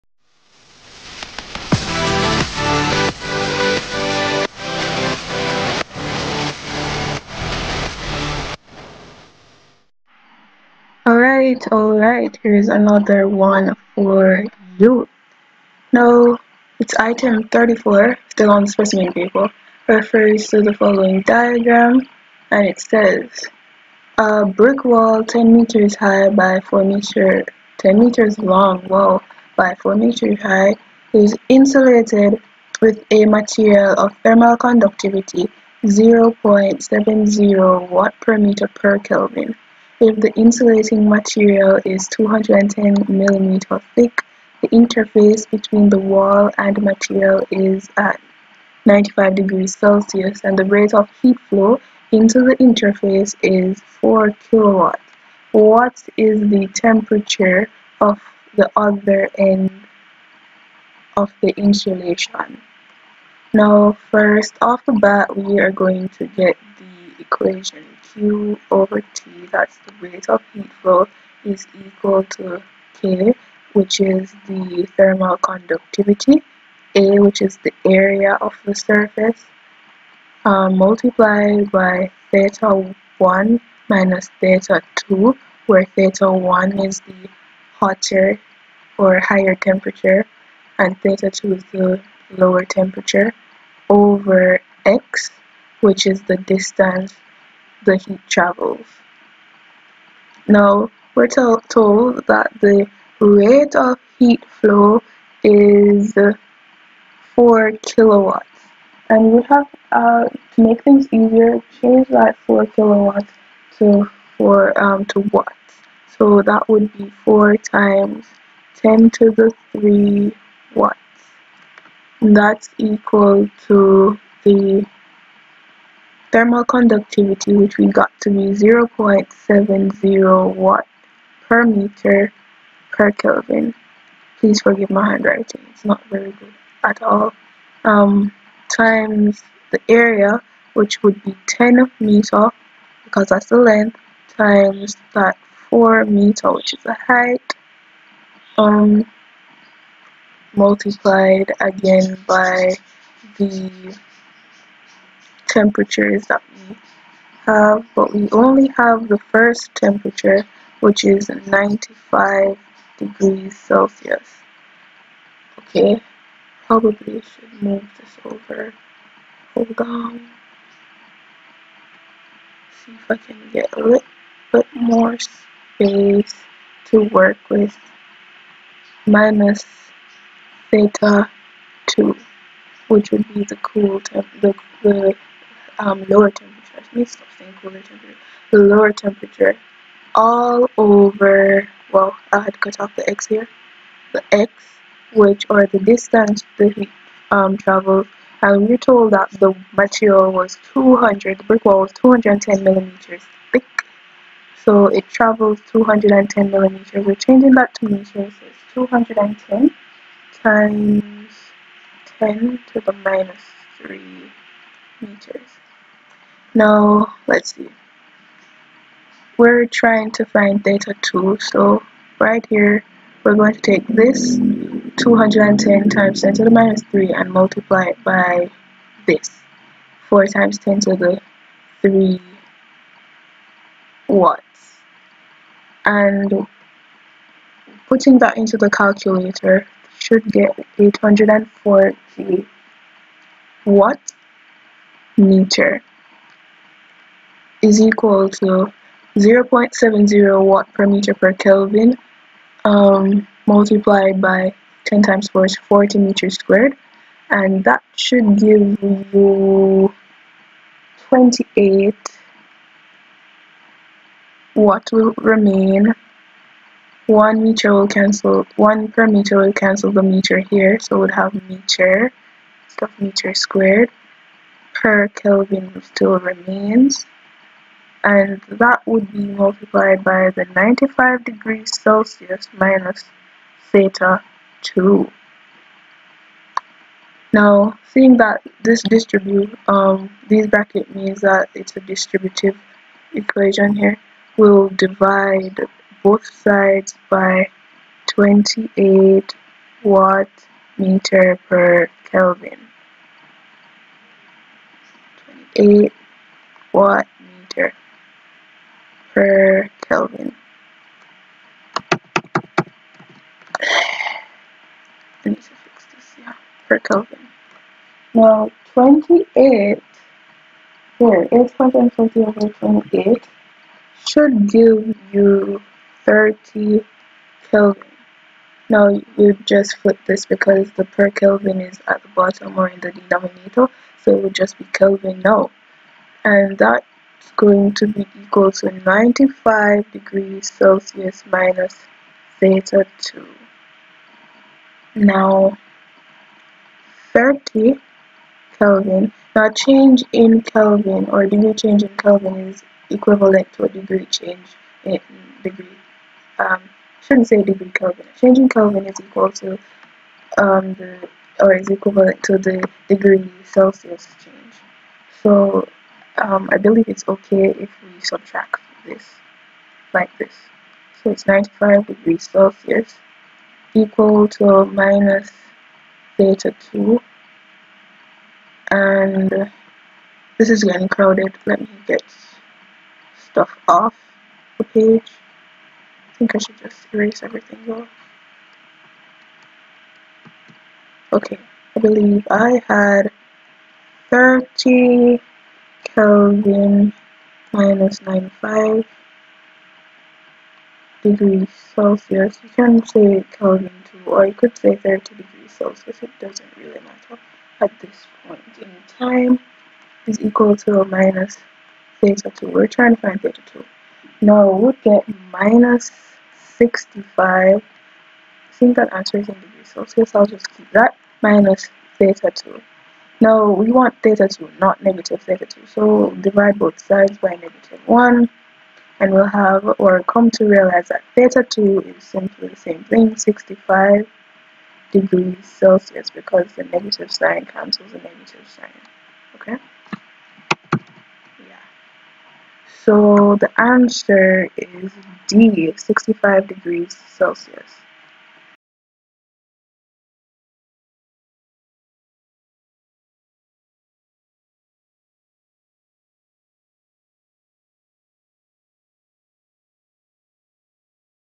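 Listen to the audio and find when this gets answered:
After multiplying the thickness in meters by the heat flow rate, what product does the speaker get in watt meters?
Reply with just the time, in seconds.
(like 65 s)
240 s.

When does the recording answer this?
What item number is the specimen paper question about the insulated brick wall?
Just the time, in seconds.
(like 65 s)
17 s.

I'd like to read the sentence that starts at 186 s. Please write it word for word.
Let me stop saying cooler temperature.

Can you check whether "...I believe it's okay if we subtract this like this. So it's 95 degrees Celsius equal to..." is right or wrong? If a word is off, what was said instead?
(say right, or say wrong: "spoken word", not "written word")
right.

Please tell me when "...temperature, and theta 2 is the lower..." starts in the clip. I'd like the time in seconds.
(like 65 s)
89 s.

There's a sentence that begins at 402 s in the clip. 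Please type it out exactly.
You can say Kelvin too, or you could say 30 degrees Celsius.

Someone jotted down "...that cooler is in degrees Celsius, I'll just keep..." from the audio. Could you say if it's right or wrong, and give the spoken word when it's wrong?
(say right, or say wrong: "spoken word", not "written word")
wrong: "answer", not "cooler".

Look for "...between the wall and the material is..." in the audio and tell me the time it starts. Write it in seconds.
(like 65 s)
45 s.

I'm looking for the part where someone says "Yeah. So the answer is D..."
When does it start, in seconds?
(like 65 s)
440 s.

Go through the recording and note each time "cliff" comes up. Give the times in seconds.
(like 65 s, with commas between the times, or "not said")
not said.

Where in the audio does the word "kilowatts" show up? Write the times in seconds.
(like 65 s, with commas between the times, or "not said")
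54 s, 107 s, 112 s.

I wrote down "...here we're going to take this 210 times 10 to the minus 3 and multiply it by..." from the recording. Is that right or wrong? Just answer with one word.
right.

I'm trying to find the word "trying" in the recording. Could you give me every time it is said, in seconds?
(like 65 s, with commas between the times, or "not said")
219 s, 412 s.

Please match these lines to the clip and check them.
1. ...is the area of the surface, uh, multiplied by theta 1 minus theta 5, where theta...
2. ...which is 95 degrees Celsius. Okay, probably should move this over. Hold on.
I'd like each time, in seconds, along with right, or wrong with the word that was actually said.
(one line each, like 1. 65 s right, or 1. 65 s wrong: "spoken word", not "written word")
1. 77 s wrong: "2", not "5"
2. 160 s right.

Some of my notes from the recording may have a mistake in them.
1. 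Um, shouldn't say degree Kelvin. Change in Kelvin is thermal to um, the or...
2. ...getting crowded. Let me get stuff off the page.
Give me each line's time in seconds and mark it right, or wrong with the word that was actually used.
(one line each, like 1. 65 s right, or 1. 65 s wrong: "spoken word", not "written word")
1. 356 s wrong: "equal", not "thermal"
2. 380 s right.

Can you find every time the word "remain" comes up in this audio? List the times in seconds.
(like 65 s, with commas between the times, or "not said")
265 s, 276 s.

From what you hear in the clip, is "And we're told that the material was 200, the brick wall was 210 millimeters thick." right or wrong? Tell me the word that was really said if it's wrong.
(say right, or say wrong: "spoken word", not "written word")
right.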